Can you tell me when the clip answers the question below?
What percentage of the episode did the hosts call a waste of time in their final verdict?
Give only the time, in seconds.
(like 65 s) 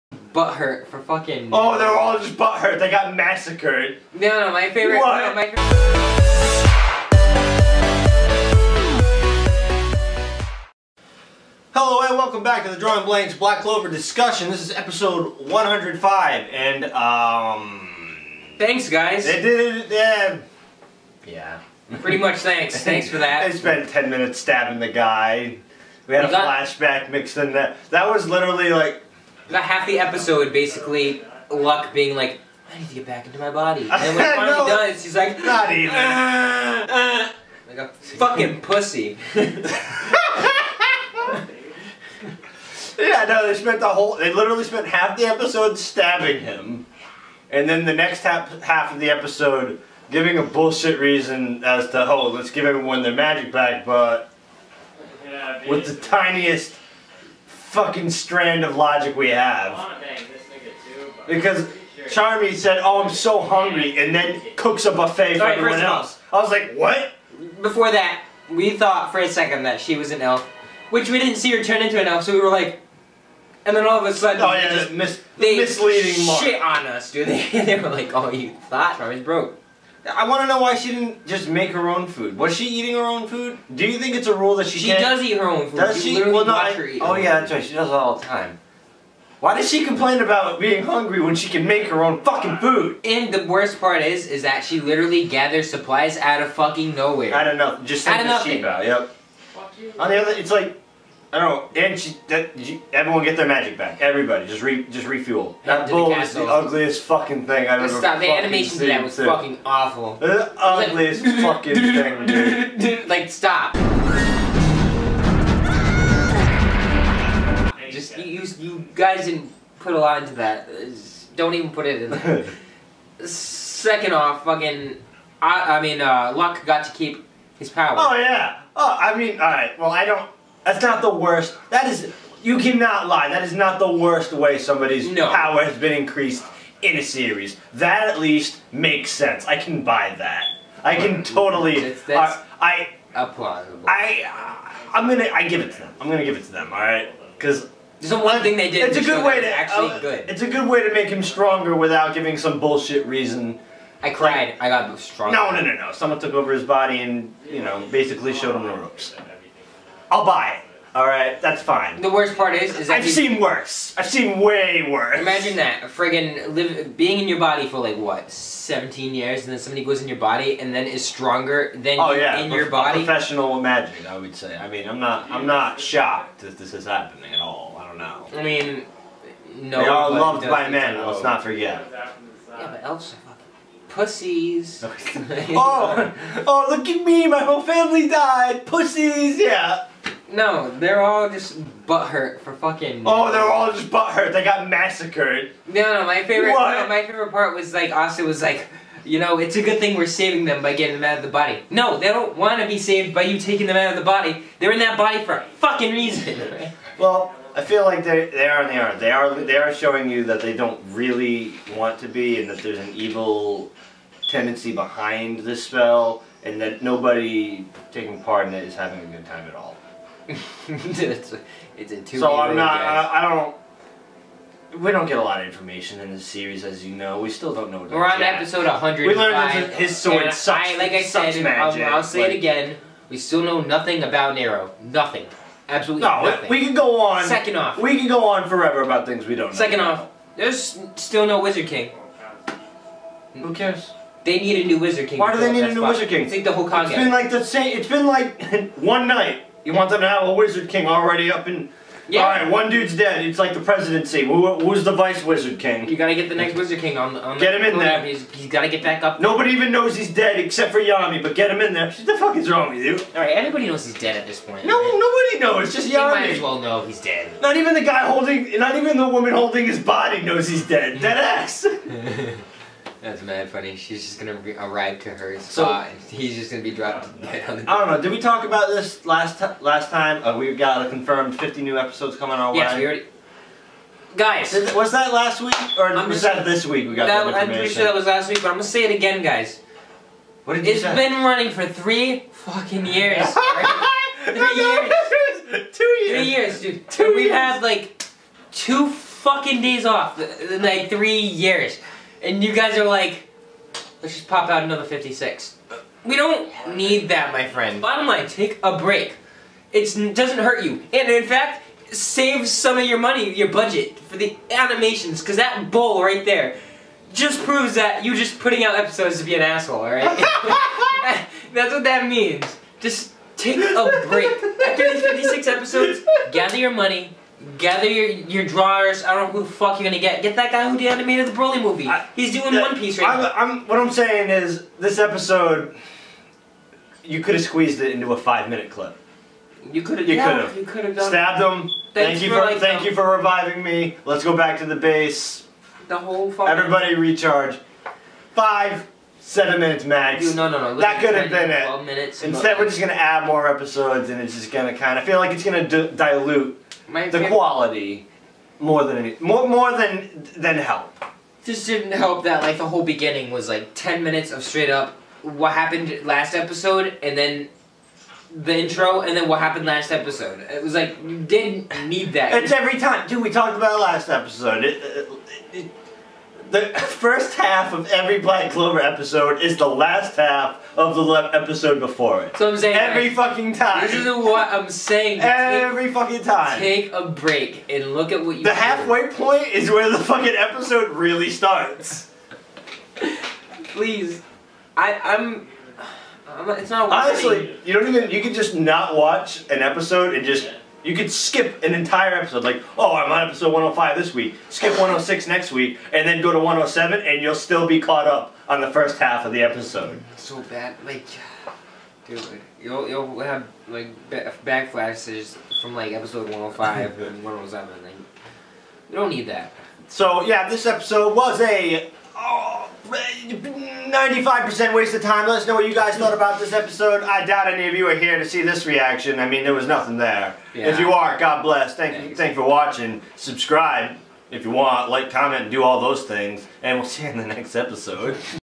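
423 s.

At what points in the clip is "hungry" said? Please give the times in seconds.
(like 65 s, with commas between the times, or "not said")
63 s, 90 s.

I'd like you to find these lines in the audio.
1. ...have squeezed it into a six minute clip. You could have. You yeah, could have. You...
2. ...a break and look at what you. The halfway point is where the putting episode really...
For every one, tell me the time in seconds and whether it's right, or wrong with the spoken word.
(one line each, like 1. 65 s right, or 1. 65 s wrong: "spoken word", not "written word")
1. 337 s wrong: "five", not "six"
2. 386 s wrong: "fucking", not "putting".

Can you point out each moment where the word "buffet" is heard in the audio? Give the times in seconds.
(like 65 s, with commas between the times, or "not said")
64 s.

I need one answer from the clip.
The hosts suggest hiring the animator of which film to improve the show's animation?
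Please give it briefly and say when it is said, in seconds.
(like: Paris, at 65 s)
the Broly movie, at 331 s.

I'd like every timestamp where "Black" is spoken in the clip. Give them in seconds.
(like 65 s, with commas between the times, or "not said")
13 s, 378 s.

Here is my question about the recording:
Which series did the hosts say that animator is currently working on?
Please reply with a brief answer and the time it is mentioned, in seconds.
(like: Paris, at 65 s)
One Piece, at 332 s.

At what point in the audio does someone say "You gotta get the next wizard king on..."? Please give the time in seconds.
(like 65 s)
255 s.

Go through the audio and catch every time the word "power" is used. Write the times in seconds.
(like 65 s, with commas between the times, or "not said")
127 s, 135 s.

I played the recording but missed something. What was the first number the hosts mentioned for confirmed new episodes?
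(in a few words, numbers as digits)
50.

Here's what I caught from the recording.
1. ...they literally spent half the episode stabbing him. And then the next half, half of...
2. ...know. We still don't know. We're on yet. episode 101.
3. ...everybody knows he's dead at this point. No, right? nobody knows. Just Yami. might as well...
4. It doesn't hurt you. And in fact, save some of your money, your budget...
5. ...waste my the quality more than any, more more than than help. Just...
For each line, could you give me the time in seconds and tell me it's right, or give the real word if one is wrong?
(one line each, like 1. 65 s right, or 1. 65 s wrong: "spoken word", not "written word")
1. 44 s right
2. 226 s wrong: "100", not "101"
3. 263 s right
4. 309 s right
5. 355 s wrong: "dilute", not "waste".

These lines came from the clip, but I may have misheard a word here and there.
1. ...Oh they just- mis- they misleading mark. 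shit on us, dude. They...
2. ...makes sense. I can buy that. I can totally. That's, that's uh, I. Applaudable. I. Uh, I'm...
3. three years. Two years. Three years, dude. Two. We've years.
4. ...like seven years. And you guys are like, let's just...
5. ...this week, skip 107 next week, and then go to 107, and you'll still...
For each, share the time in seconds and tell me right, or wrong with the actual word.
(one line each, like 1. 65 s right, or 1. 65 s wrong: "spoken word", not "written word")
1. 74 s right
2. 138 s right
3. 295 s right
4. 300 s wrong: "three", not "seven"
5. 403 s wrong: "106", not "107".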